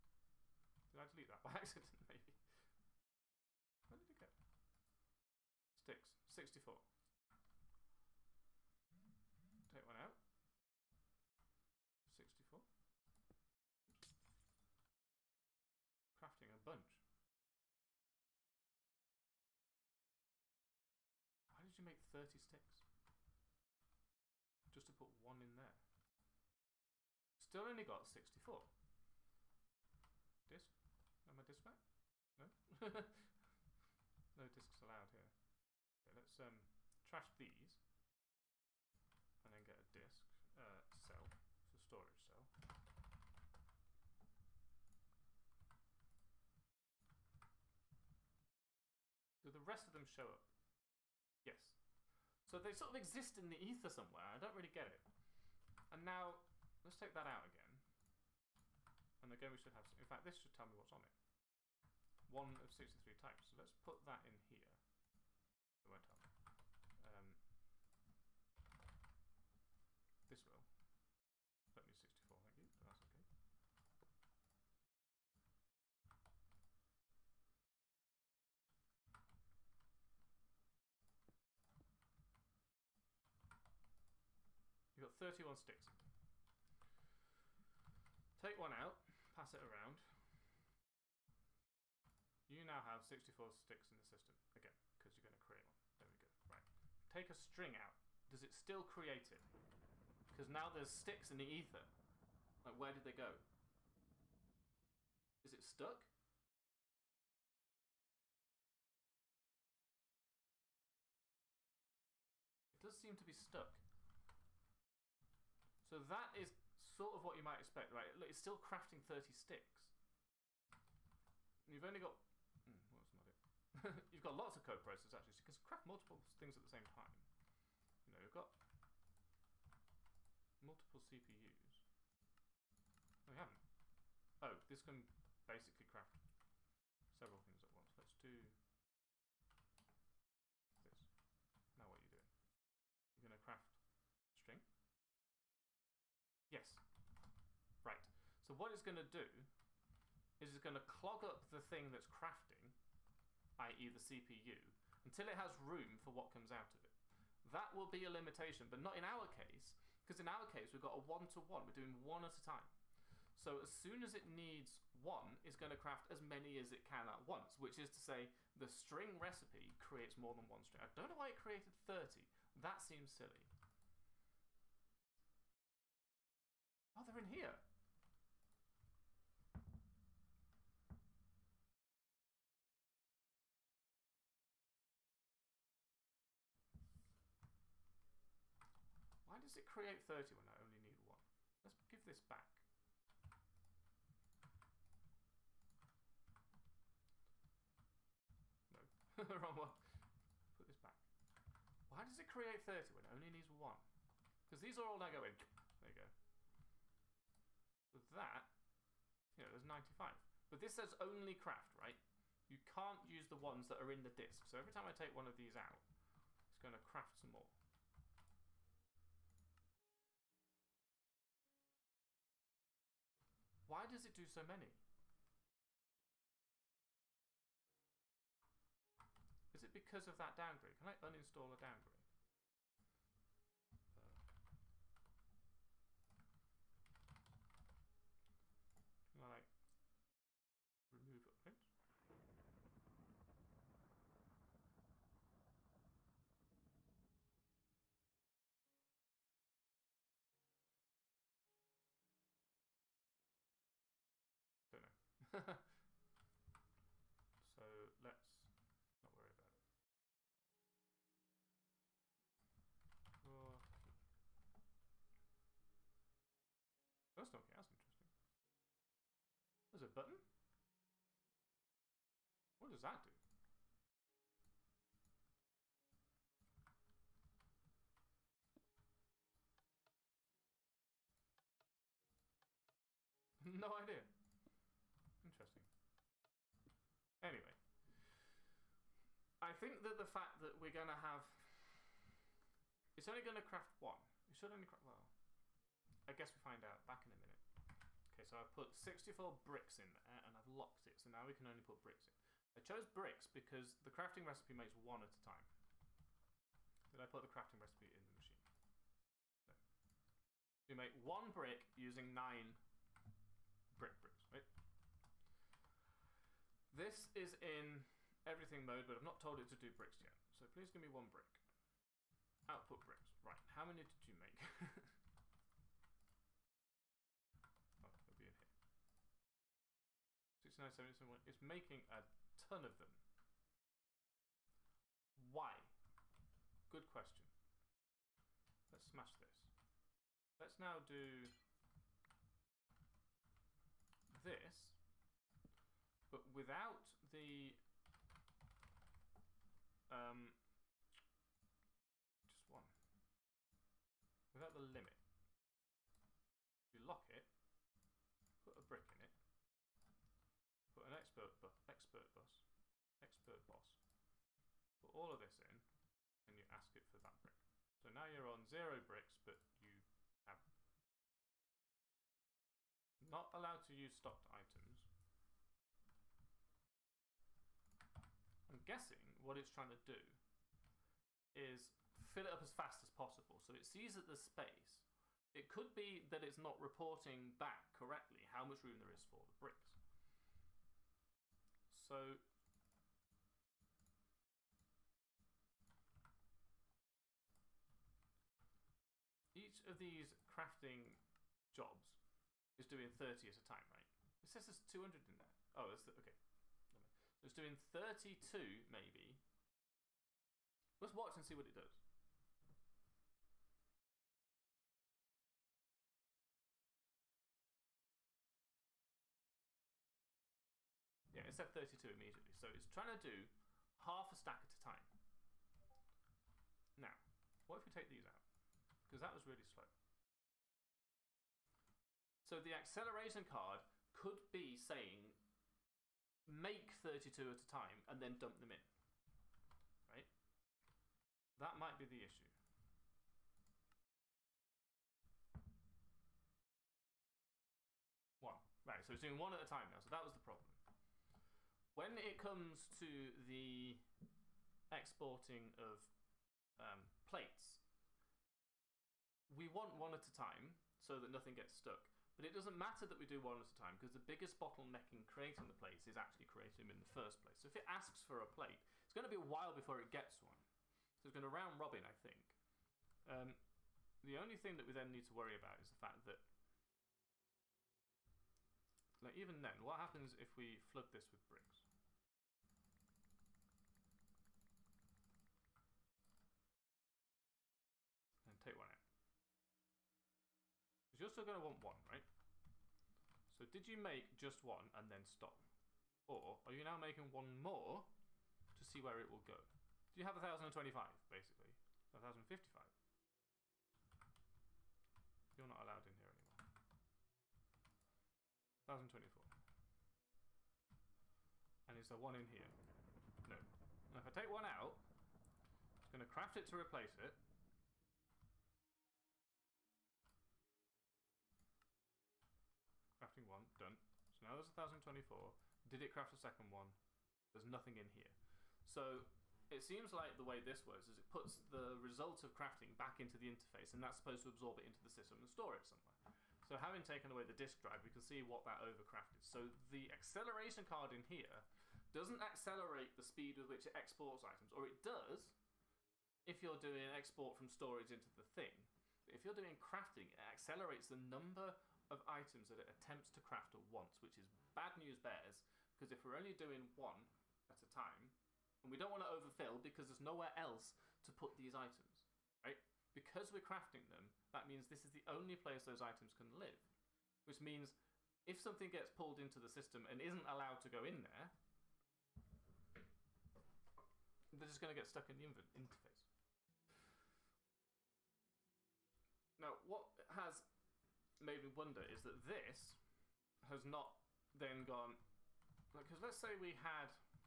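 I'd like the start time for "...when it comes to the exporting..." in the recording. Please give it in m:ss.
7:31.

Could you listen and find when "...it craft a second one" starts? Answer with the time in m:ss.
8:45.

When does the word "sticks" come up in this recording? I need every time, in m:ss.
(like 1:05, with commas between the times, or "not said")
0:05, 0:22, 1:25, 1:33, 1:40, 1:59.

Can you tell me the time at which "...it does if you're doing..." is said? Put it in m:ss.
9:04.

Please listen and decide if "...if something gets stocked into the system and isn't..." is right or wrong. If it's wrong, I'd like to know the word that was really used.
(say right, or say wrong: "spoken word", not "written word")
wrong: "pulled", not "stocked".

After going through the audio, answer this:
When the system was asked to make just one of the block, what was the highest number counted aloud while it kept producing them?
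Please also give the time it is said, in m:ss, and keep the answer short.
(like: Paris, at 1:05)
71, at 5:30.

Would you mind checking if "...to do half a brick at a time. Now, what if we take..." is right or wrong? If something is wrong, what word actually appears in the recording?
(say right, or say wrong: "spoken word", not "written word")
wrong: "stack", not "brick".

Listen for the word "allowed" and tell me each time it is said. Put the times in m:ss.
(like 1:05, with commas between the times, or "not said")
0:34, 6:13, 8:25, 9:30.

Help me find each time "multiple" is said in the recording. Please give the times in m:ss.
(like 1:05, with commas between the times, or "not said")
2:05, 2:10.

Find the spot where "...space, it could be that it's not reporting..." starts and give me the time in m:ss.
6:24.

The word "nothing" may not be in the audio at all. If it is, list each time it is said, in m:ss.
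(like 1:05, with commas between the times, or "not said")
7:41, 8:47.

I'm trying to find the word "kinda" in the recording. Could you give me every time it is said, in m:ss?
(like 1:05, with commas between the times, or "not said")
not said.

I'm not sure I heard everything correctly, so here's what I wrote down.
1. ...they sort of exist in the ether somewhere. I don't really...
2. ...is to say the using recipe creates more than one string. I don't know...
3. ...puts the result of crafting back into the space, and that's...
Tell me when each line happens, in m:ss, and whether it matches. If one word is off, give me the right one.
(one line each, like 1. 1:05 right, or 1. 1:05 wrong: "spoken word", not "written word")
1. 0:52 right
2. 2:47 wrong: "string", not "using"
3. 8:51 wrong: "interface", not "space".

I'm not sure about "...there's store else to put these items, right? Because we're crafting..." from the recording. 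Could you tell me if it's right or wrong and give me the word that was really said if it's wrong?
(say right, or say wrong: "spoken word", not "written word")
wrong: "nowhere", not "store".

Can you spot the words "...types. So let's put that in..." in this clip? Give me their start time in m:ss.
1:03.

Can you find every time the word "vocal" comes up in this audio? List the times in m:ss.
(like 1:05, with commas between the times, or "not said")
not said.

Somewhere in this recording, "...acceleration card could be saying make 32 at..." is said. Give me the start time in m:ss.
7:12.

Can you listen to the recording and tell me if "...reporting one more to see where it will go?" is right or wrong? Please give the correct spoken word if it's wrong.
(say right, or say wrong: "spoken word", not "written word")
wrong: "making", not "reporting".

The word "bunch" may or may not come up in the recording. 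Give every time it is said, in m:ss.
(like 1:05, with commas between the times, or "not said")
0:16.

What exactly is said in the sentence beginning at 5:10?
We make one brick using nine brick bricks, right?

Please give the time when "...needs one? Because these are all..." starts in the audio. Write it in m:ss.
3:23.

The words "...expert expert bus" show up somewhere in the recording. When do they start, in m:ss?
6:00.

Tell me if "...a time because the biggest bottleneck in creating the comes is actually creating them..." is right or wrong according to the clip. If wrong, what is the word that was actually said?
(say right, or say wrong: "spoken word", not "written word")
wrong: "plates", not "comes".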